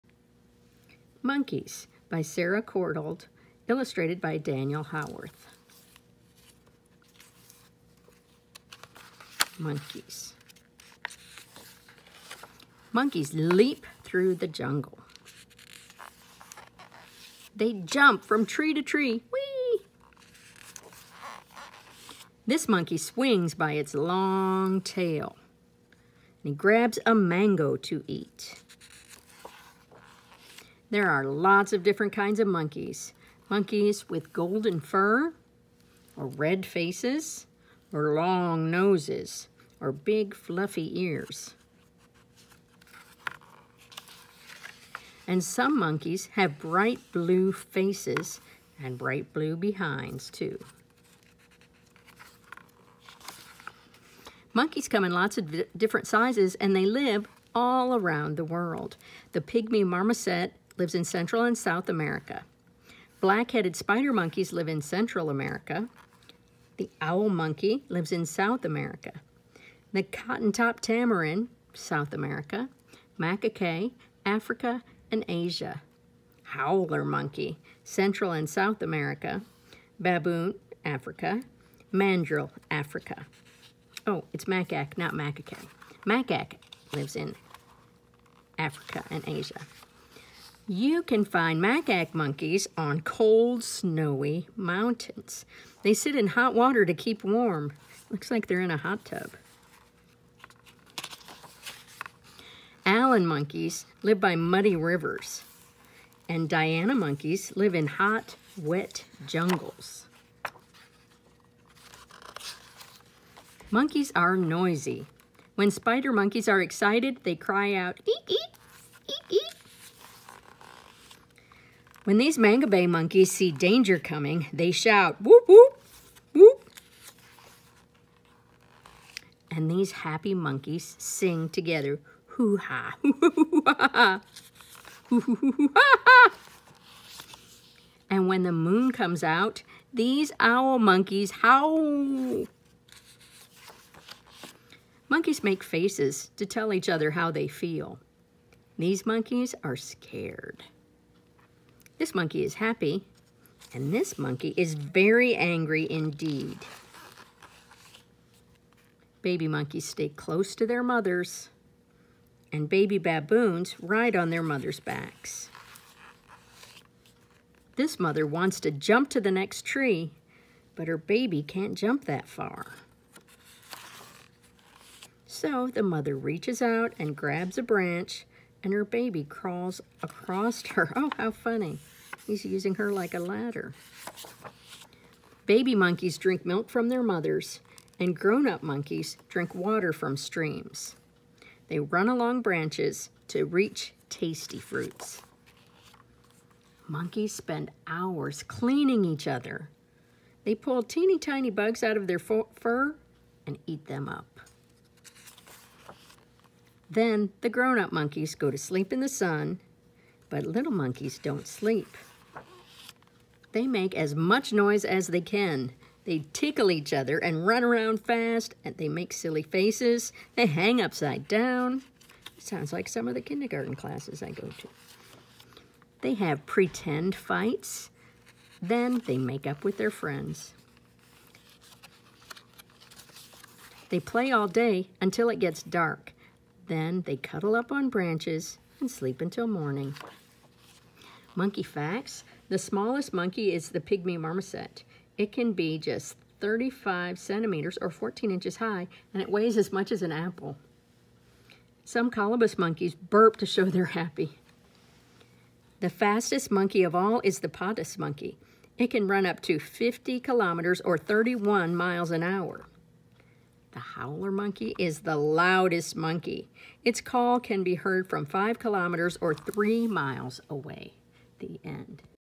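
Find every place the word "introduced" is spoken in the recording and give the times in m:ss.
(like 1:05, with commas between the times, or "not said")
not said.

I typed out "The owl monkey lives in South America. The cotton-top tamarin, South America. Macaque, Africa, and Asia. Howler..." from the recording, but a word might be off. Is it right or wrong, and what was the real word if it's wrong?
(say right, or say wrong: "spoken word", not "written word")
right.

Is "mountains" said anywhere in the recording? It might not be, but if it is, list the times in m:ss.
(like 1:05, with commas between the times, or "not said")
1:34.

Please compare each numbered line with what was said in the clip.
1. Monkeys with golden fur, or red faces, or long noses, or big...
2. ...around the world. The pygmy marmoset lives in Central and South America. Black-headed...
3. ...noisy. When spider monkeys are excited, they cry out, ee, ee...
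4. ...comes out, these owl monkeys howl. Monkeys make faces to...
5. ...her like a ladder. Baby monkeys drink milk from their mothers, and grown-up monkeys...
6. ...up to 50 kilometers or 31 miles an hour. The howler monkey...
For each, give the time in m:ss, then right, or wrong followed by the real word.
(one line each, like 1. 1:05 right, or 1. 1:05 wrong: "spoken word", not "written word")
1. 0:33 right
2. 0:57 right
3. 1:54 right
4. 2:18 right
5. 3:02 right
6. 4:19 right.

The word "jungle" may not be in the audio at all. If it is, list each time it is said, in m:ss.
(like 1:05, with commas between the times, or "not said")
0:14, 1:49.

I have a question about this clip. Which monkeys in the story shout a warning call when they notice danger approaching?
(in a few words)
mangabey monkeys.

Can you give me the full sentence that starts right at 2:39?
Baby monkeys stay close to their mothers, and baby baboons ride on their mother's backs.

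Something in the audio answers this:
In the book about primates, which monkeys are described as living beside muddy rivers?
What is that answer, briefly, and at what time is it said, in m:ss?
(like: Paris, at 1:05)
Allen monkeys, at 1:42.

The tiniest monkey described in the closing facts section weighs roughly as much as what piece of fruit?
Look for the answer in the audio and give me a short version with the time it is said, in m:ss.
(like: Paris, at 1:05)
an apple, at 4:10.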